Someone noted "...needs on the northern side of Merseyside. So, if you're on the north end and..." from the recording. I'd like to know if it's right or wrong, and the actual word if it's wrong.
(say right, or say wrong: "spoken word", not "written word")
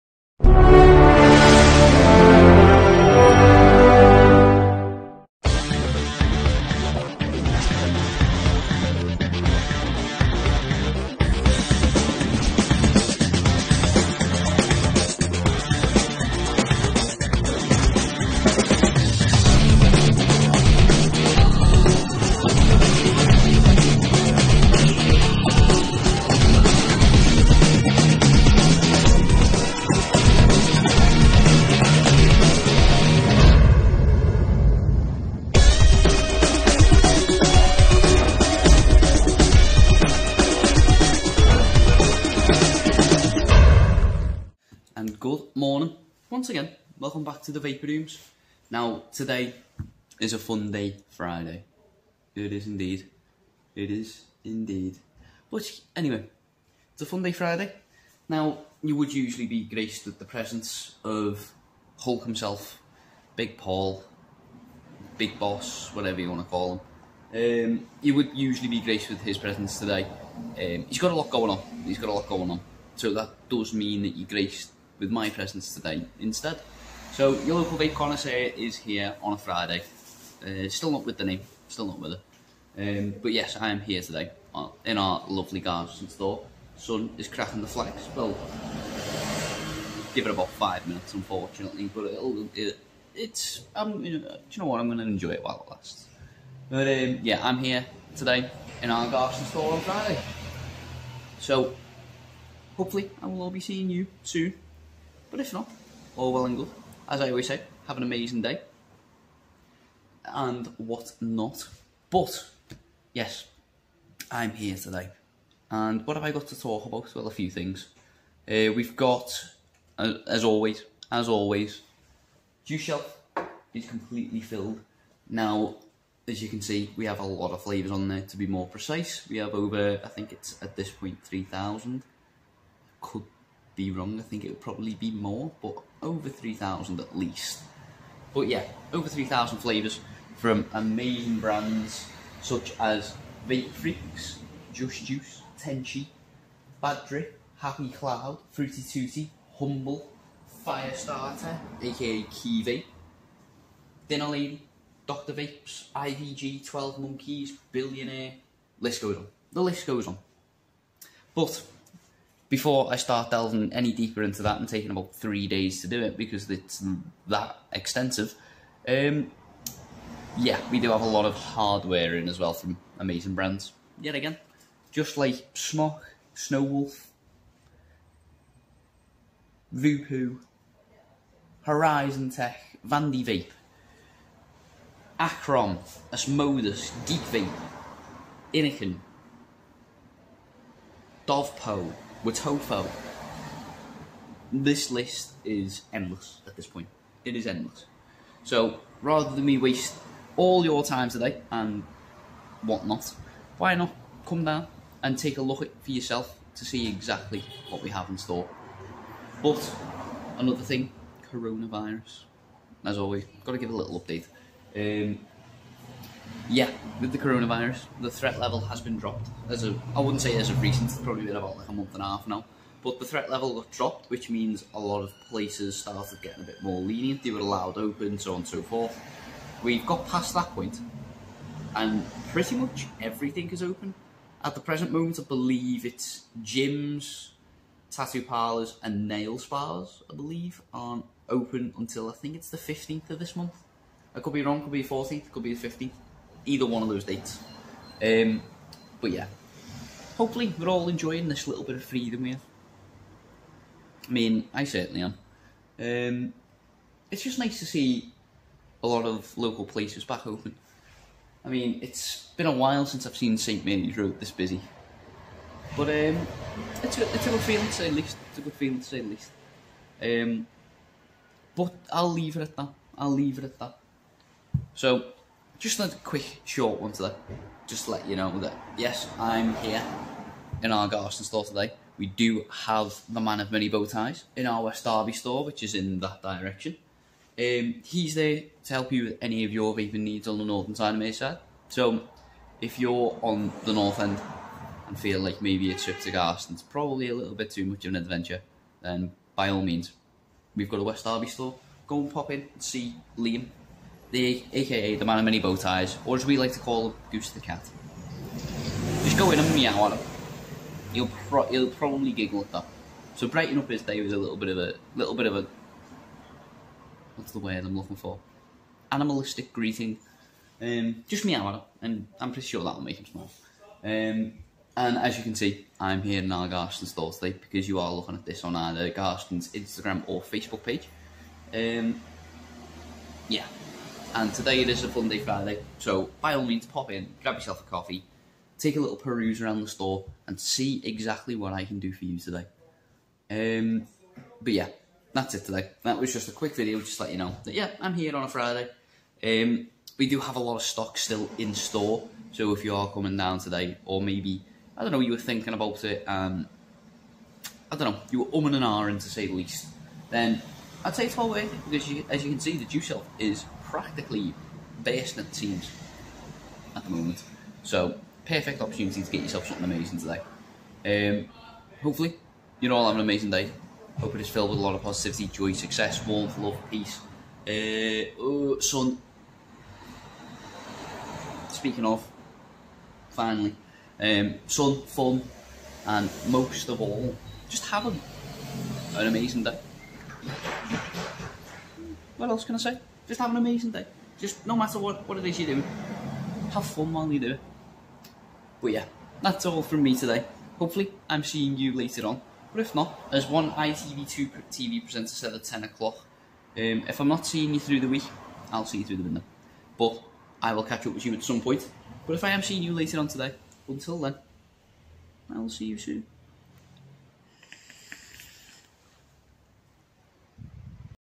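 right.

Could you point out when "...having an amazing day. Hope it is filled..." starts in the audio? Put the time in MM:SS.
06:12.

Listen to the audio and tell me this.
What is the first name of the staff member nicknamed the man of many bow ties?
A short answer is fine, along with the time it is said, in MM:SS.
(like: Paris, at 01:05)
Liam, at 05:03.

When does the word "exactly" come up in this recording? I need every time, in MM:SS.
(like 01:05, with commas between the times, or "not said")
03:26, 05:40.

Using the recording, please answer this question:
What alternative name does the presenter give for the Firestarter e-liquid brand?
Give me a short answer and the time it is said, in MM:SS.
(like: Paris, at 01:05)
Key Dinner Lady, at 02:32.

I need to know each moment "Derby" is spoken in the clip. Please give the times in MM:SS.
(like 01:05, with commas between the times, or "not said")
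04:44, 05:01.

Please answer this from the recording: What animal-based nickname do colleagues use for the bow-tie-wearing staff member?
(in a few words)
Goose the Cat.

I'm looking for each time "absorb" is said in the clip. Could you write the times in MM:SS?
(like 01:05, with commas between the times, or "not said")
not said.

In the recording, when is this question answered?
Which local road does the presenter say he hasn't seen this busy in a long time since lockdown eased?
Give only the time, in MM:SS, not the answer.
04:23.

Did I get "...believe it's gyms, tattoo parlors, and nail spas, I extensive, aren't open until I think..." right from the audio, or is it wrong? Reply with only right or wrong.
wrong.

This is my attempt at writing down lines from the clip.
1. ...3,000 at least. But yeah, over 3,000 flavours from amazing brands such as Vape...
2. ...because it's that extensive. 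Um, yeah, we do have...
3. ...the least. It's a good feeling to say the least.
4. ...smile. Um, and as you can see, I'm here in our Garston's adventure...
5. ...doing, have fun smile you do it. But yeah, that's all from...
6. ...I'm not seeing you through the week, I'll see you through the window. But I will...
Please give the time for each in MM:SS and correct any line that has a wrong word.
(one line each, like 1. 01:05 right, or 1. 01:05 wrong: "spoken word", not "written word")
1. 02:16 right
2. 02:46 right
3. 04:27 right
4. 05:23 wrong: "store", not "adventure"
5. 06:35 wrong: "while", not "smile"
6. 06:47 right.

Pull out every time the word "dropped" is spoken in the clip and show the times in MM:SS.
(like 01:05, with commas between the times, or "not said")
03:38, 03:43.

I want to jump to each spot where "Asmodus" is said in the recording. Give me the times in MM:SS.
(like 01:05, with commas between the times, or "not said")
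03:06.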